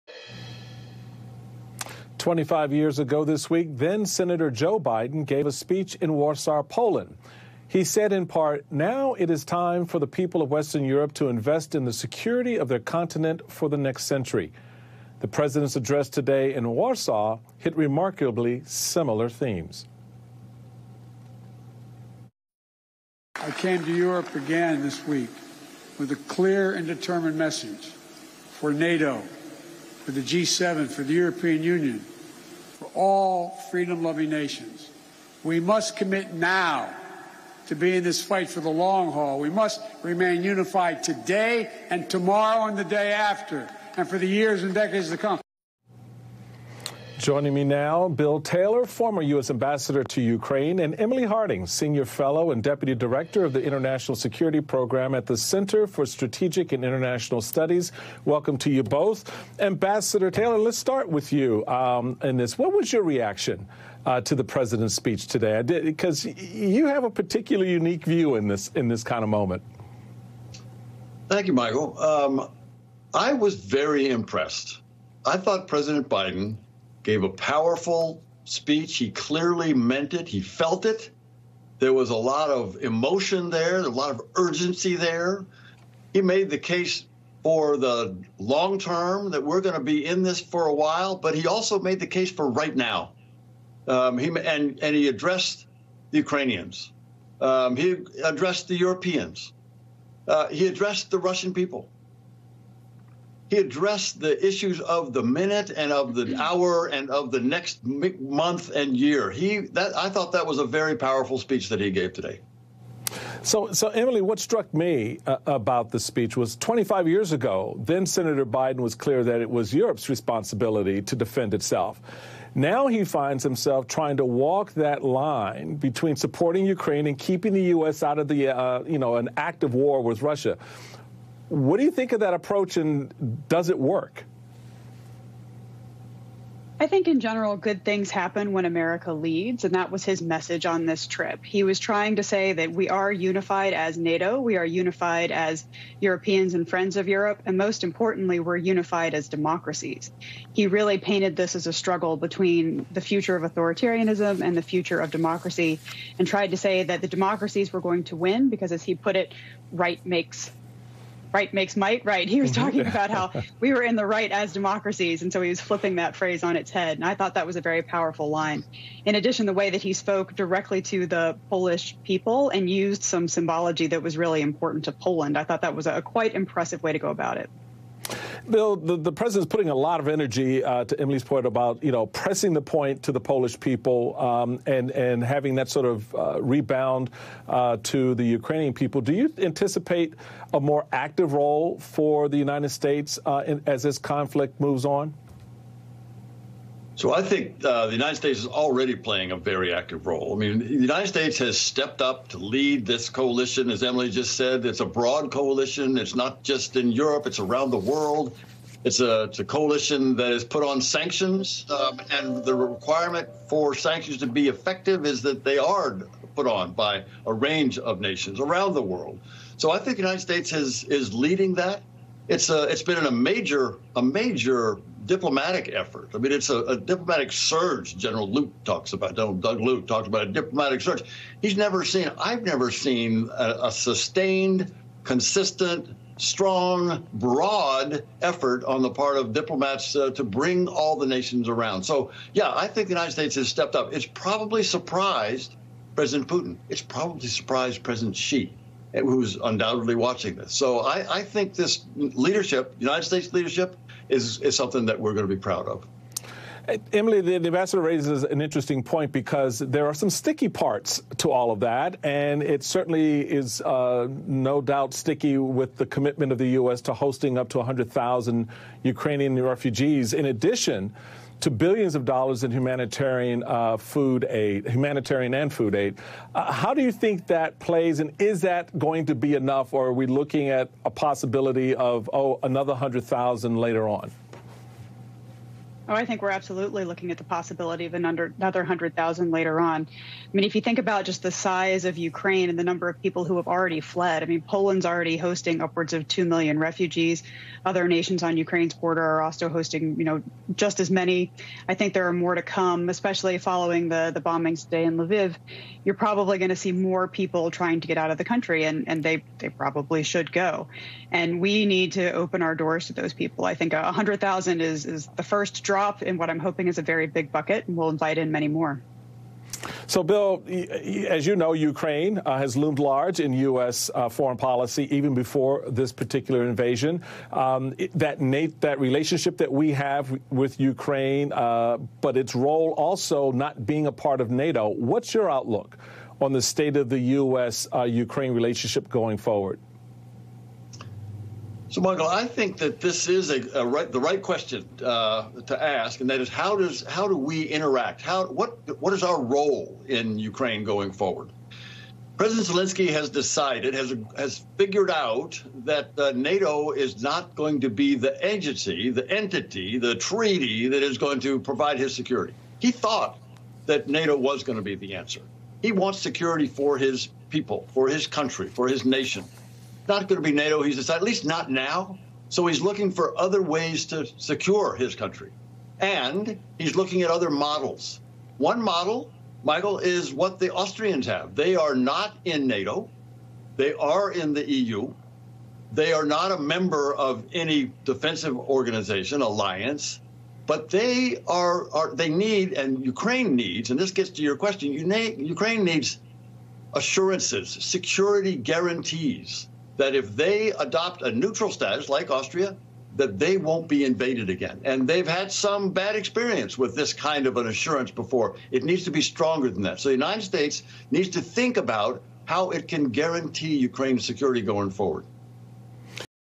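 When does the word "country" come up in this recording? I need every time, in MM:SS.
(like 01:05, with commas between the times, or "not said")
05:08, 06:08, 06:14.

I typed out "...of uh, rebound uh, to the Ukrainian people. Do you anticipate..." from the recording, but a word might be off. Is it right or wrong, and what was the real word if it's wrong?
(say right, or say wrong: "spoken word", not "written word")
right.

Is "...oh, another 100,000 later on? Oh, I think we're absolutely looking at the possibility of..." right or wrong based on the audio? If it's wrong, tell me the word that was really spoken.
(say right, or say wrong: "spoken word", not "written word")
right.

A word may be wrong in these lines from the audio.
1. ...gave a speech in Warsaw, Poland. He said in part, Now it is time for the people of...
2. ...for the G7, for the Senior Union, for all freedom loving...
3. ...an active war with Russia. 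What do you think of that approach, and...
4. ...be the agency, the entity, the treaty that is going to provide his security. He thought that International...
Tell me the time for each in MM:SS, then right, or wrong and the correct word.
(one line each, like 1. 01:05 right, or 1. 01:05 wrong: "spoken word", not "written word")
1. 00:05 right
2. 00:30 wrong: "European", not "Senior"
3. 02:09 right
4. 05:57 wrong: "NATO", not "International".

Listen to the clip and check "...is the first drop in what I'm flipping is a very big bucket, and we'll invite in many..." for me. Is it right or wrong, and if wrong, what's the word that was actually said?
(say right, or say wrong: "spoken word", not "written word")
wrong: "hoping", not "flipping".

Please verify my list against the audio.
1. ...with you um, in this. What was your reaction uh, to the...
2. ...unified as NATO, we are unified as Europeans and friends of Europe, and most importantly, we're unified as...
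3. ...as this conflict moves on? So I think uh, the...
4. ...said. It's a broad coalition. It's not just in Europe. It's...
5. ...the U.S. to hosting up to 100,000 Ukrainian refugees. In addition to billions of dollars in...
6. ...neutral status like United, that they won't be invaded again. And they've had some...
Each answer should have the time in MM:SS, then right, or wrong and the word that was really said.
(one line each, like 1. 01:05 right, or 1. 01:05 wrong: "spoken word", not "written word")
1. 01:01 right
2. 02:23 right
3. 03:13 right
4. 03:24 right
5. 04:26 right
6. 06:41 wrong: "Austria", not "United".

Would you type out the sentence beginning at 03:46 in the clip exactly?
I mean, it's a, a, diplomatic surge.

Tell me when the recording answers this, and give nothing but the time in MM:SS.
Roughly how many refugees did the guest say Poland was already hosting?
04:56.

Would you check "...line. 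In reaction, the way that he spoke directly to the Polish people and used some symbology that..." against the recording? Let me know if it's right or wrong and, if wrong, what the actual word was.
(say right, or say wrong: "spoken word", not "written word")
wrong: "addition", not "reaction".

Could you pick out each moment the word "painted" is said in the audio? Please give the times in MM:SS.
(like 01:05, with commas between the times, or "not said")
02:30.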